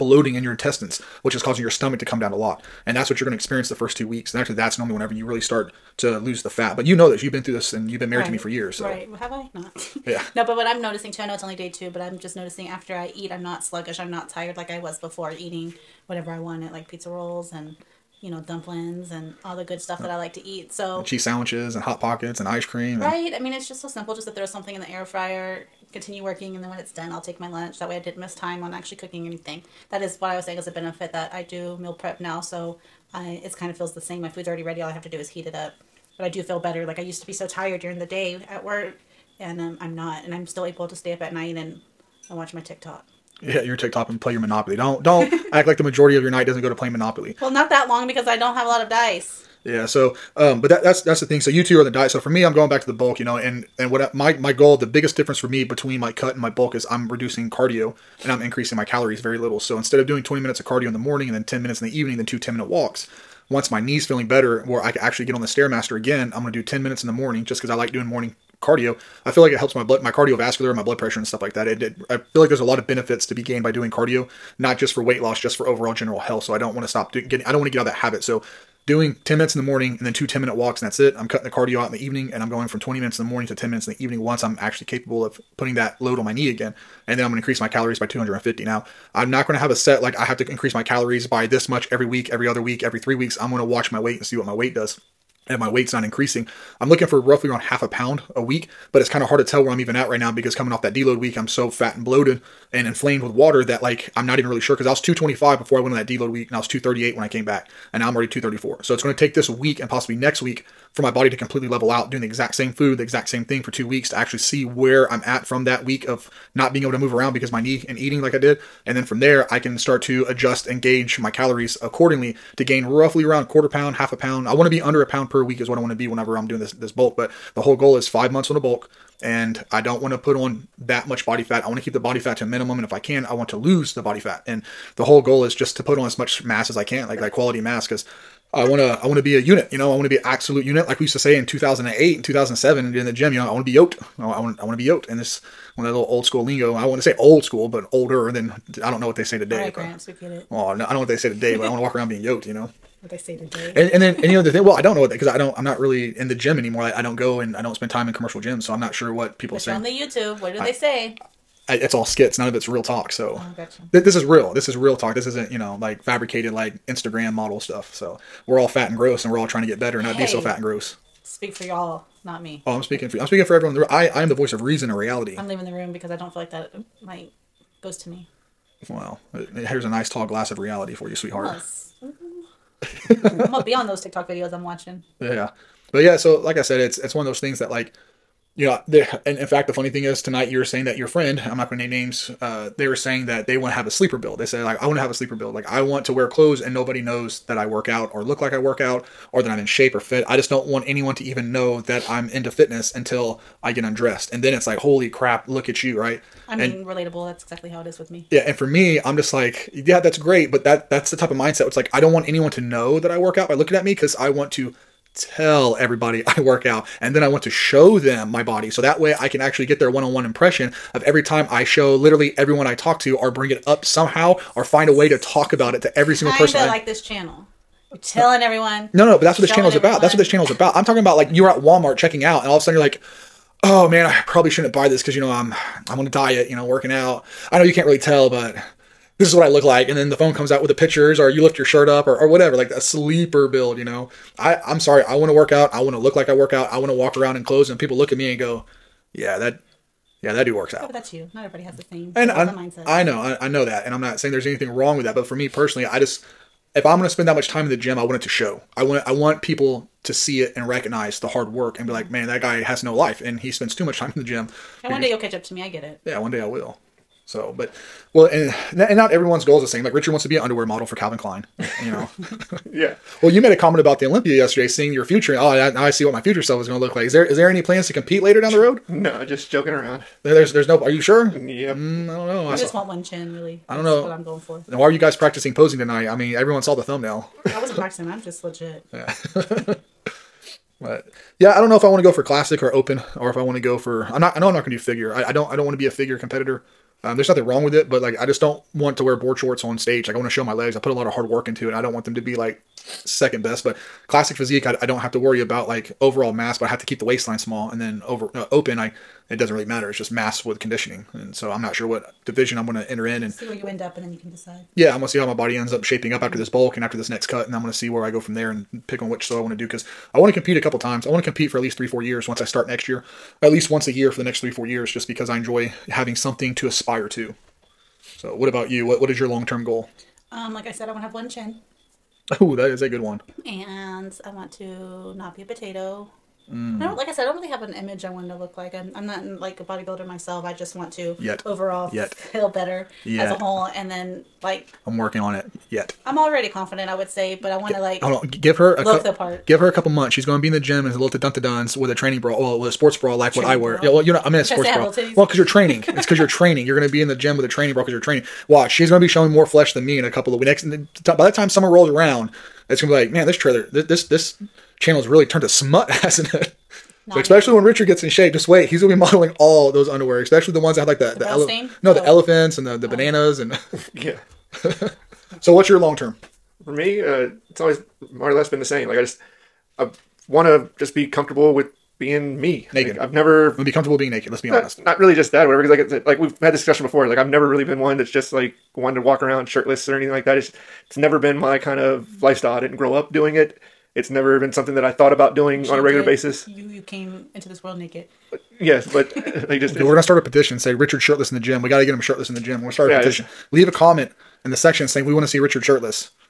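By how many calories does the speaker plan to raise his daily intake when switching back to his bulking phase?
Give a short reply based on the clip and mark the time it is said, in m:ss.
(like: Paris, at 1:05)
250, at 1:28.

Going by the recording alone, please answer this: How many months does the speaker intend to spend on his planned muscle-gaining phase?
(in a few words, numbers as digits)
five months.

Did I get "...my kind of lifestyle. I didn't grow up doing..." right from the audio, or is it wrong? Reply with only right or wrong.
right.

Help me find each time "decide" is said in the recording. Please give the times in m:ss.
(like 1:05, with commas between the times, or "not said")
5:14.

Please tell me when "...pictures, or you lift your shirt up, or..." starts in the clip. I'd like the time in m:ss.
4:00.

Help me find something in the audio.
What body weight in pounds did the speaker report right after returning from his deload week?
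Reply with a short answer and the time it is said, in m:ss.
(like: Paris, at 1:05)
238, at 1:46.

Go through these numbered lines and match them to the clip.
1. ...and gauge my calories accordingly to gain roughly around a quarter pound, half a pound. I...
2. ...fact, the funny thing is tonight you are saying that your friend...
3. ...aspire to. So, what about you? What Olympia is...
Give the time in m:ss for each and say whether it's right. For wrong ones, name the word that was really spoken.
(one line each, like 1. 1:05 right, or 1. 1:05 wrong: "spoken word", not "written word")
1. 2:00 right
2. 3:09 right
3. 5:26 wrong: "What", not "Olympia".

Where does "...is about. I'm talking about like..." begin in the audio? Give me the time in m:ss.
3:50.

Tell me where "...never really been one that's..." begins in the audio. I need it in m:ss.
6:27.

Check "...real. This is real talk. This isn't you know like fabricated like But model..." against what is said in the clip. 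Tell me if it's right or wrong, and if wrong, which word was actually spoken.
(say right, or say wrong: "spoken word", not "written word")
wrong: "Instagram", not "But".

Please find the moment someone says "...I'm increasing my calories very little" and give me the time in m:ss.
0:58.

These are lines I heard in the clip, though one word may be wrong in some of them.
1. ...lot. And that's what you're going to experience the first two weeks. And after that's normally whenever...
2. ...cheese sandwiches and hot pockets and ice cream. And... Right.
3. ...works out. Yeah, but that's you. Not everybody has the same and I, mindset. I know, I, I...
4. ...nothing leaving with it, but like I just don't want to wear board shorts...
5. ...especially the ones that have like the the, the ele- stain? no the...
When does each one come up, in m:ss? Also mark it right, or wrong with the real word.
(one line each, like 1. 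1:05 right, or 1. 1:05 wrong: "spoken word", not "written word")
1. 0:02 right
2. 0:21 right
3. 4:10 right
4. 4:57 wrong: "wrong", not "leaving"
5. 6:10 right.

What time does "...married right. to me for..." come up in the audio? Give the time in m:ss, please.
0:08.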